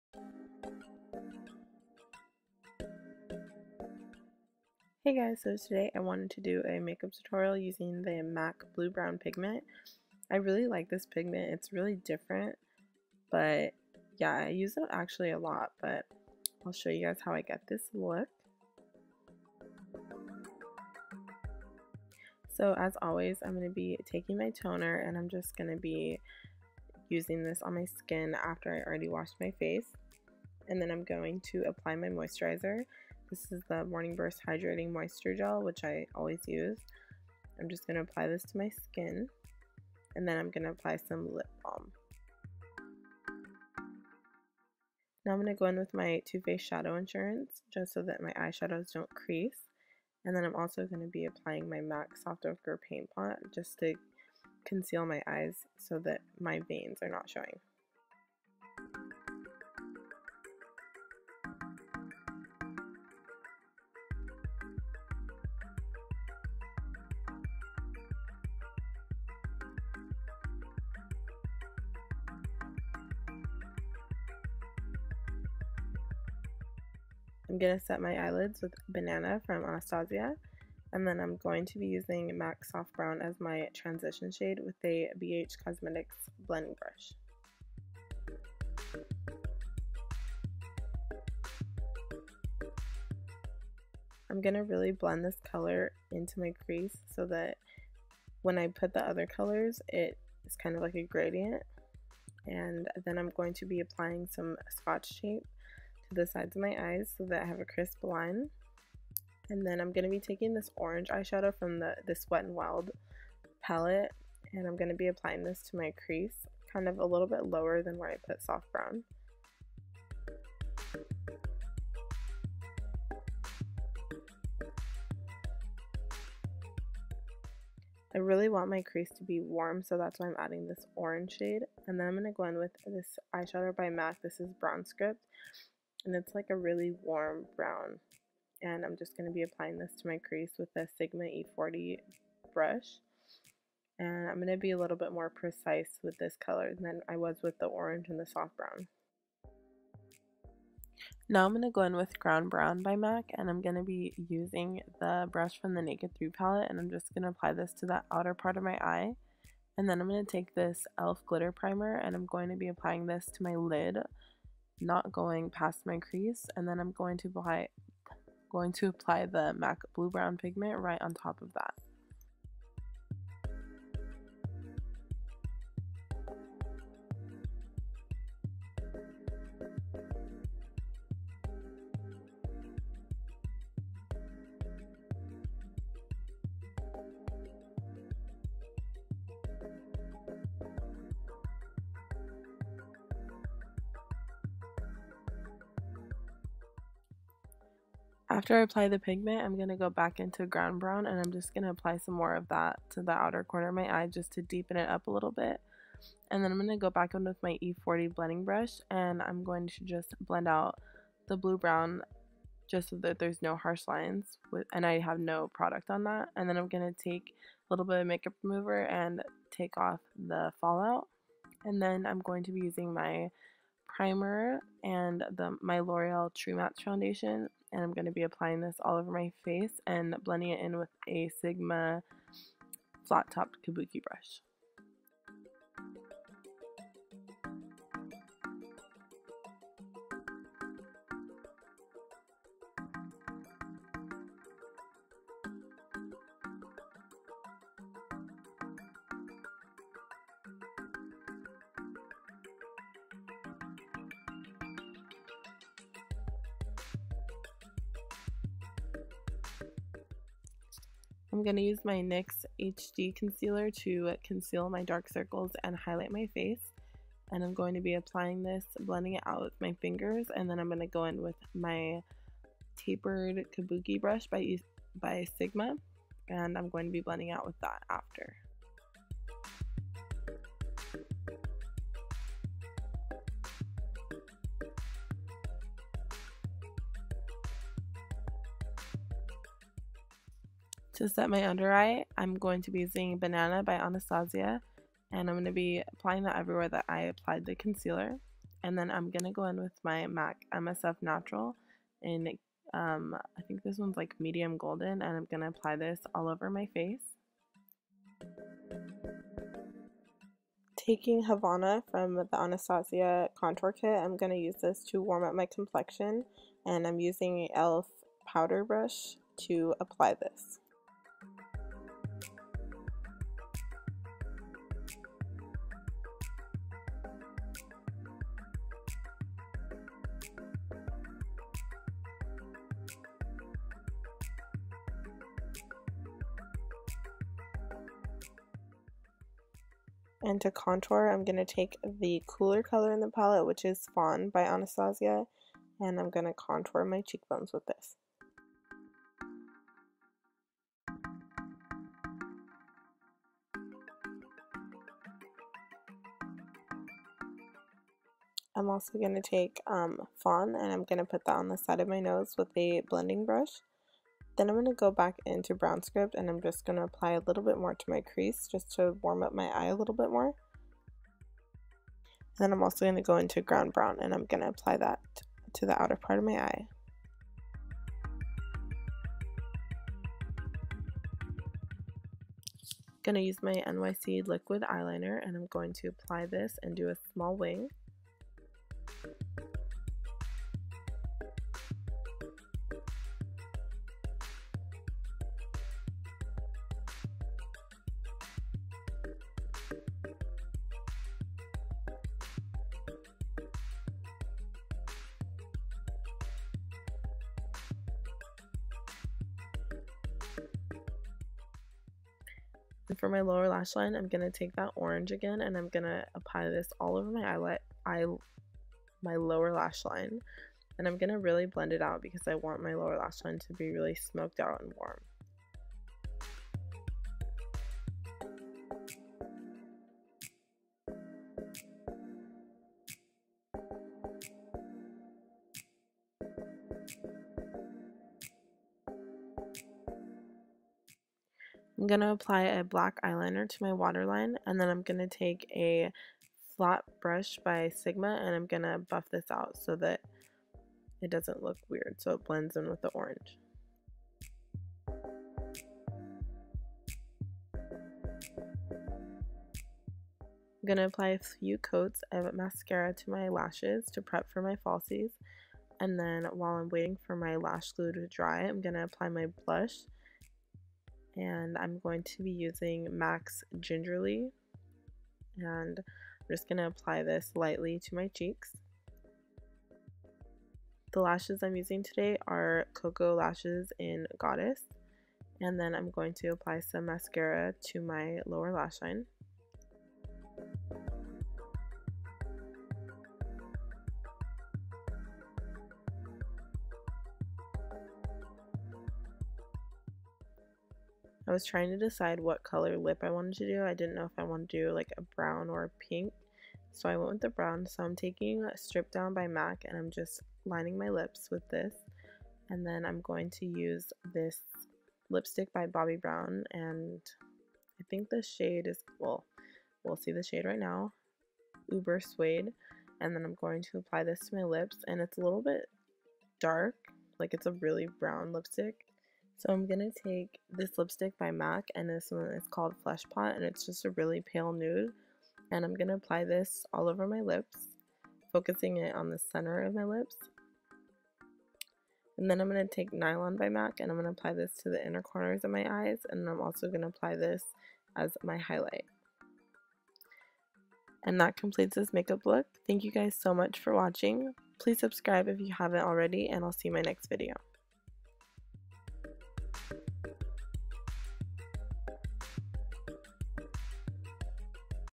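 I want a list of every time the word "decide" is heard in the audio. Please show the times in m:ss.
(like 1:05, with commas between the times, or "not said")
8:21.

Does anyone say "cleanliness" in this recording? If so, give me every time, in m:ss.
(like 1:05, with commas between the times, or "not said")
not said.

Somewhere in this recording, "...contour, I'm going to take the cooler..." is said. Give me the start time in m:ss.
5:40.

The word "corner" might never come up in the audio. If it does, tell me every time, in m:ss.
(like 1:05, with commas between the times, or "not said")
3:23, 9:05.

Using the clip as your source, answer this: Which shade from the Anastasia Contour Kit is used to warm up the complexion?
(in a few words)
Havana.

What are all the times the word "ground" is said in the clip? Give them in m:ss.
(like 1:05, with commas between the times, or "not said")
2:32, 3:20, 6:13.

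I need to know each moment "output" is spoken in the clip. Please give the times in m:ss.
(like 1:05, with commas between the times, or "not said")
not said.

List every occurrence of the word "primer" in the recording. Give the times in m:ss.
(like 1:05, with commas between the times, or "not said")
2:41, 3:43.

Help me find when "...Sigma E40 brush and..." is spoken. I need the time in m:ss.
2:20.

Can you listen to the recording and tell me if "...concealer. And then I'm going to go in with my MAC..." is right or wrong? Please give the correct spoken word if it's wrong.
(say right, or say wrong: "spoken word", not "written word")
right.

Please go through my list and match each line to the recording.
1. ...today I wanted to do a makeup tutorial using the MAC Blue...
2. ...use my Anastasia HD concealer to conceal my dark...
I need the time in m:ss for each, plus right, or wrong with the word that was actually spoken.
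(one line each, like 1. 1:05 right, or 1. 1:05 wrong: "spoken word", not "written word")
1. 0:05 right
2. 4:21 wrong: "NYX", not "Anastasia".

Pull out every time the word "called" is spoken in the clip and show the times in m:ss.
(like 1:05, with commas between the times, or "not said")
8:52.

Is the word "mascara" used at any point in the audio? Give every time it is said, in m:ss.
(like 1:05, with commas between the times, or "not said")
7:42, 8:06.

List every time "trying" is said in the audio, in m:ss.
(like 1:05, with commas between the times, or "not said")
8:21.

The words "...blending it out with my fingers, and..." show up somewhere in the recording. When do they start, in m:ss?
4:28.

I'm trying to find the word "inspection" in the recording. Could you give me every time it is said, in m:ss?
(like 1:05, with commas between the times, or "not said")
not said.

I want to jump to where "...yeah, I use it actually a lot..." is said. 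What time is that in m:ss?
0:14.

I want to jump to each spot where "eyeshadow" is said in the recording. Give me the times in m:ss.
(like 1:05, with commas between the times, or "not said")
0:48, 1:51, 2:13.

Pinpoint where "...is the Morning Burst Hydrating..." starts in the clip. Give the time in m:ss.
0:33.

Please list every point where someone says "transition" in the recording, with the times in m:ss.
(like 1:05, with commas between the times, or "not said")
1:23.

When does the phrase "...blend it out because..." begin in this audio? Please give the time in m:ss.
7:01.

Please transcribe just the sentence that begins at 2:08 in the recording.
I really want my crease to be warm, so that's why I'm adding this orange shade.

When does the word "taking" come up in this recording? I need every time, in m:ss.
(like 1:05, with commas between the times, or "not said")
0:24, 1:50, 5:10, 8:27.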